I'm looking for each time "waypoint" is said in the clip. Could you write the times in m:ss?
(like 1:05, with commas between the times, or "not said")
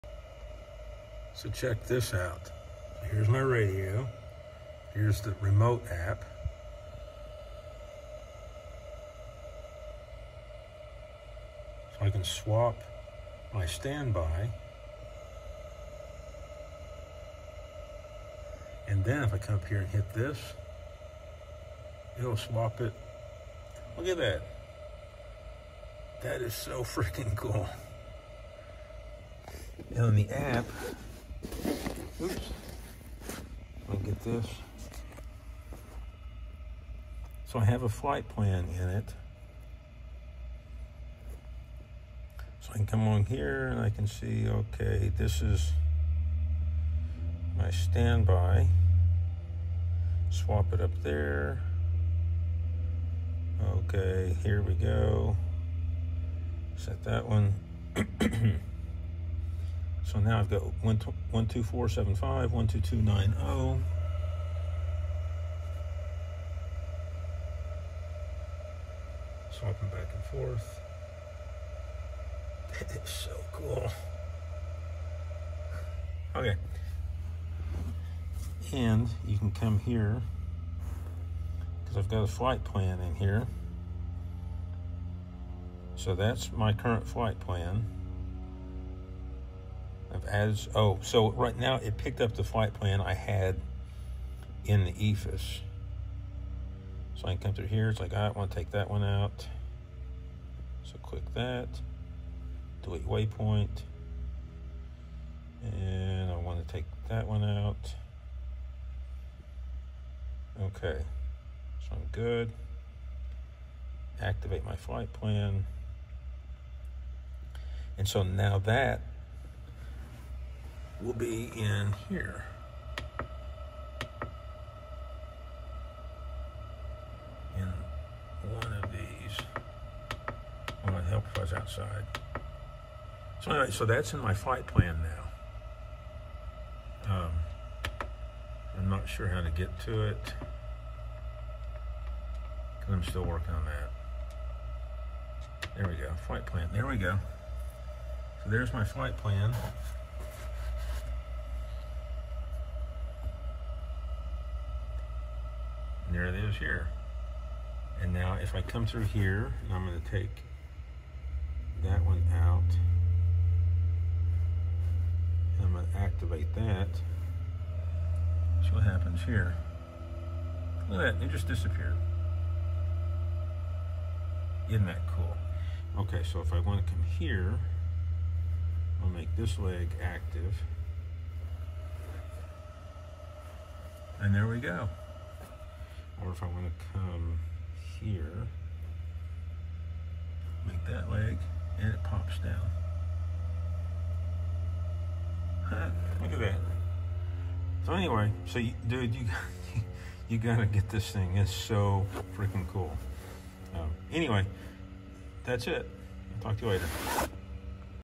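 1:43.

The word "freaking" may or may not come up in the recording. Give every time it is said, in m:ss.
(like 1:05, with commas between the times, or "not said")
0:26, 3:22.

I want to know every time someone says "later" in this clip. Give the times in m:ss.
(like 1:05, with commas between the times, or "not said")
3:26.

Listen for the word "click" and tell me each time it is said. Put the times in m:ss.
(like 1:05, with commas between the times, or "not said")
1:41.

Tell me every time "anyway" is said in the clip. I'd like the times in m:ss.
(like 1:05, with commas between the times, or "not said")
2:13, 3:17, 3:24.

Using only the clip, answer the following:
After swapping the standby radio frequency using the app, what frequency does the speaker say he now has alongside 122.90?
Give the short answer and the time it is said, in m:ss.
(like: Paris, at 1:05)
124.75, at 1:00.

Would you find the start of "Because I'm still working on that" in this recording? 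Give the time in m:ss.
2:22.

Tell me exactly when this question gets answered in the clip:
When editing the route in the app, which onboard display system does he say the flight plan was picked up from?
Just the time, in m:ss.
1:34.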